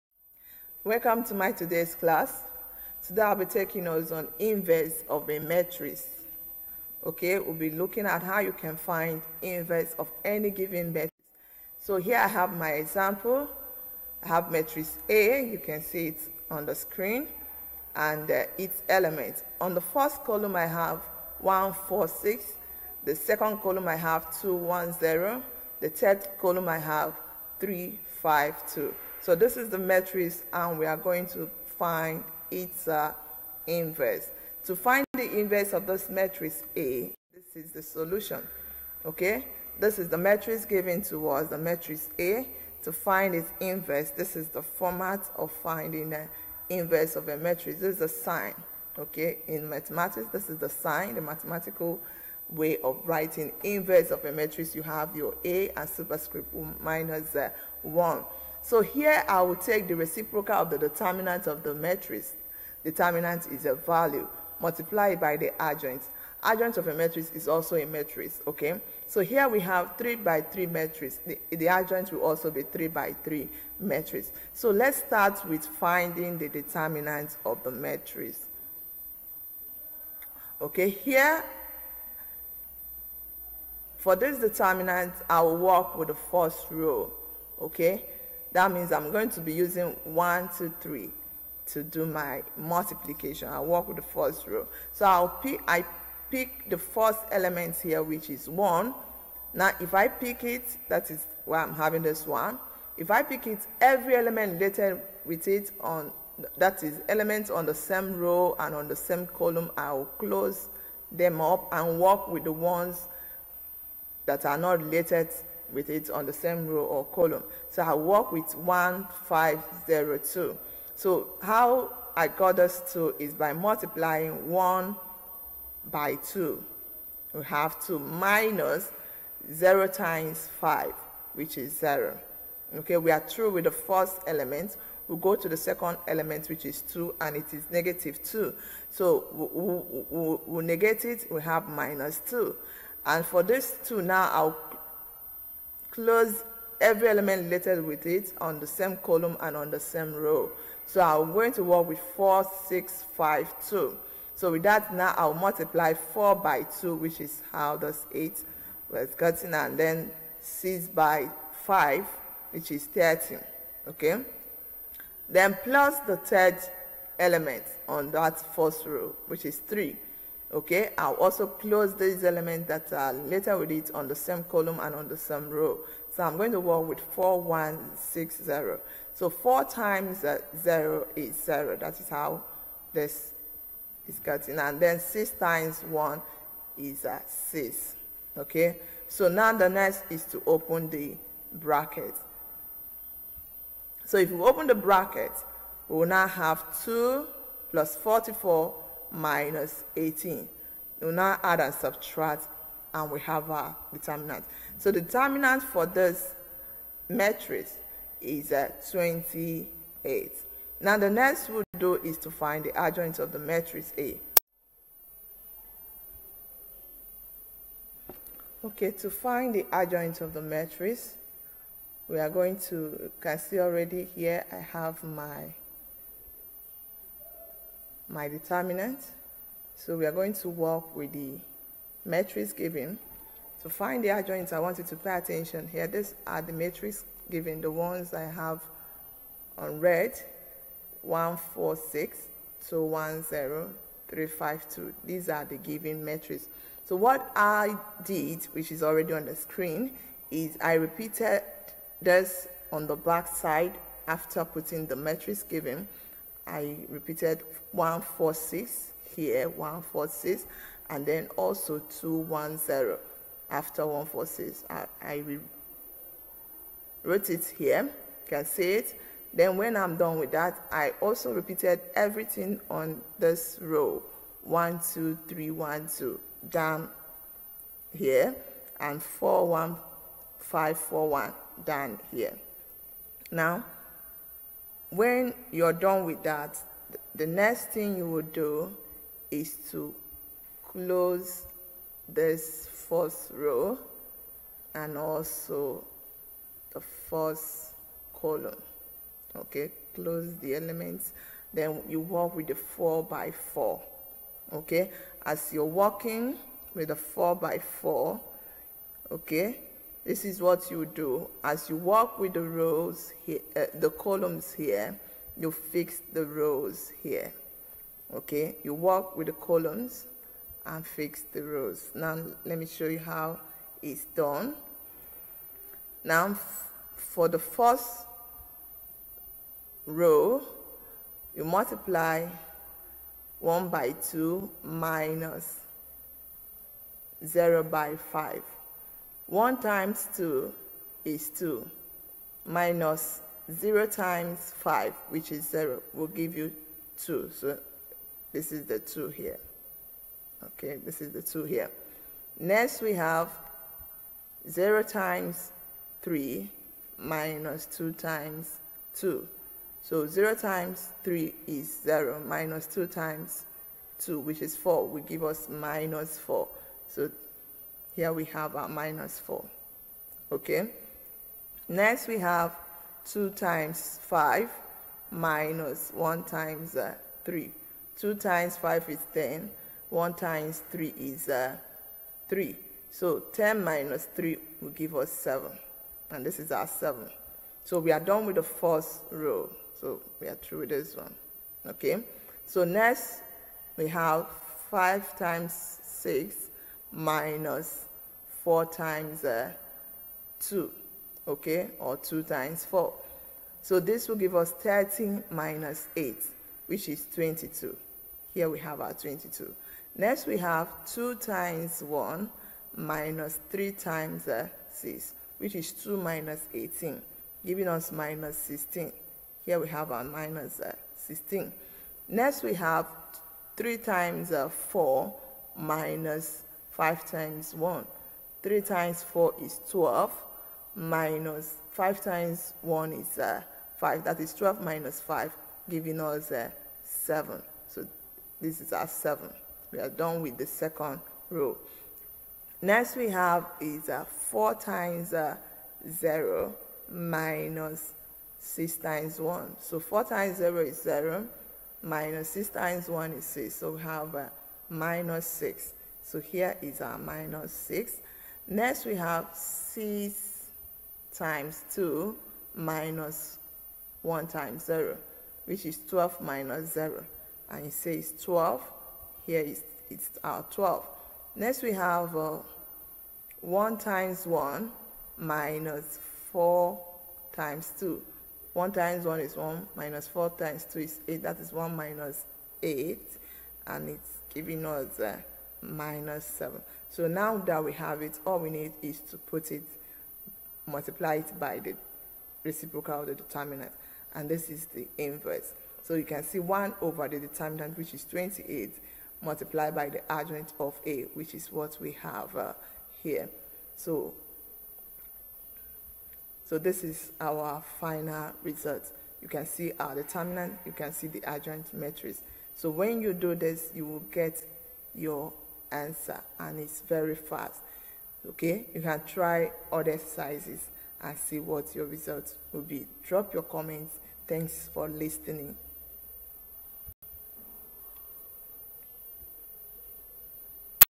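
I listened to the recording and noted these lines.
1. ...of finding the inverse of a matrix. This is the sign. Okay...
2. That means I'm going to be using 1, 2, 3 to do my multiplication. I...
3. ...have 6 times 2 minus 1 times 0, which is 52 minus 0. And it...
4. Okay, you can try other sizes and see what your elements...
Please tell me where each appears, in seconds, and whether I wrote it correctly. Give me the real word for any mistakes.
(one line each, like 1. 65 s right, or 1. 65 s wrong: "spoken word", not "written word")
1. 45 s right
2. 88 s right
3. 458 s wrong: "12", not "52"
4. 518 s wrong: "results", not "elements".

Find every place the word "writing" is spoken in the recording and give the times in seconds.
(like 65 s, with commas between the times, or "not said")
53 s.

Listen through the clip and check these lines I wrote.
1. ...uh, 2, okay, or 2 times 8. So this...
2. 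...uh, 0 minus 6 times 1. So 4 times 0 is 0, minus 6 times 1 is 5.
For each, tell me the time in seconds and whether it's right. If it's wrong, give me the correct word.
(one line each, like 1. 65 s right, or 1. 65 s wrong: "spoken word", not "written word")
1. 399 s wrong: "4", not "8"
2. 445 s wrong: "6", not "5".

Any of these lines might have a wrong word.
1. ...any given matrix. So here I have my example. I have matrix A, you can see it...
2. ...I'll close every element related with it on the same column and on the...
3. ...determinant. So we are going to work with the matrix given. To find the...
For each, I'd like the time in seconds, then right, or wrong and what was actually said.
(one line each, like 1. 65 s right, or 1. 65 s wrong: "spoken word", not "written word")
1. 10 s right
2. 144 s right
3. 228 s right.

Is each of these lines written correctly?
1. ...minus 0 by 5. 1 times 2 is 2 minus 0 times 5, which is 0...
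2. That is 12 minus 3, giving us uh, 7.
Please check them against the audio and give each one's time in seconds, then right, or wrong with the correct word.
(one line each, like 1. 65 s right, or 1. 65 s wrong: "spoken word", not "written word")
1. 334 s right
2. 434 s wrong: "5", not "3".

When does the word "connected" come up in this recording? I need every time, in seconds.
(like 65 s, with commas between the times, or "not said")
not said.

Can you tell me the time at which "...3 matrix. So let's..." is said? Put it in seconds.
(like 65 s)
73 s.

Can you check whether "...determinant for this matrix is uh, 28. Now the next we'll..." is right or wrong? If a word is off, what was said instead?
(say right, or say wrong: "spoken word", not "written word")
right.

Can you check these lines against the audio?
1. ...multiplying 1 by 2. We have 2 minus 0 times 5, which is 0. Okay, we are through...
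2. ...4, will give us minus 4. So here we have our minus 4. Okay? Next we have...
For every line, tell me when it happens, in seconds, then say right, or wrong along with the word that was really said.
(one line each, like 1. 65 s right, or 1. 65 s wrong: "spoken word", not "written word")
1. 123 s right
2. 364 s right.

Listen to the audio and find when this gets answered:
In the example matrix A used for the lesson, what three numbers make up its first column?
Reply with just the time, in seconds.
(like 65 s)
21 s.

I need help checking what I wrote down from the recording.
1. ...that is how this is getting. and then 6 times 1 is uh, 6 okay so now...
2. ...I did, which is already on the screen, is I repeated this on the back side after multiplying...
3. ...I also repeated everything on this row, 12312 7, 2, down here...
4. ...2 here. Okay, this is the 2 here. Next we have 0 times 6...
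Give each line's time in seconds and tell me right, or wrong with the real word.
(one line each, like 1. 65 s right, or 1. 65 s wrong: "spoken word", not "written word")
1. 181 s right
2. 247 s wrong: "putting", not "multiplying"
3. 270 s wrong: "1", not "7"
4. 348 s wrong: "3", not "6".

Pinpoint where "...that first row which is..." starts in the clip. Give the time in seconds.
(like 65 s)
168 s.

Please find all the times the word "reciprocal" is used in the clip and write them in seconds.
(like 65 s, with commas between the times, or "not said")
59 s, 492 s.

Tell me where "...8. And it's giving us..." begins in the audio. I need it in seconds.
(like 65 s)
482 s.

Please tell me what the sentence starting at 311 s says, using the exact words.
As you work with the rows, here, uh, the columns here, you fix the rows here.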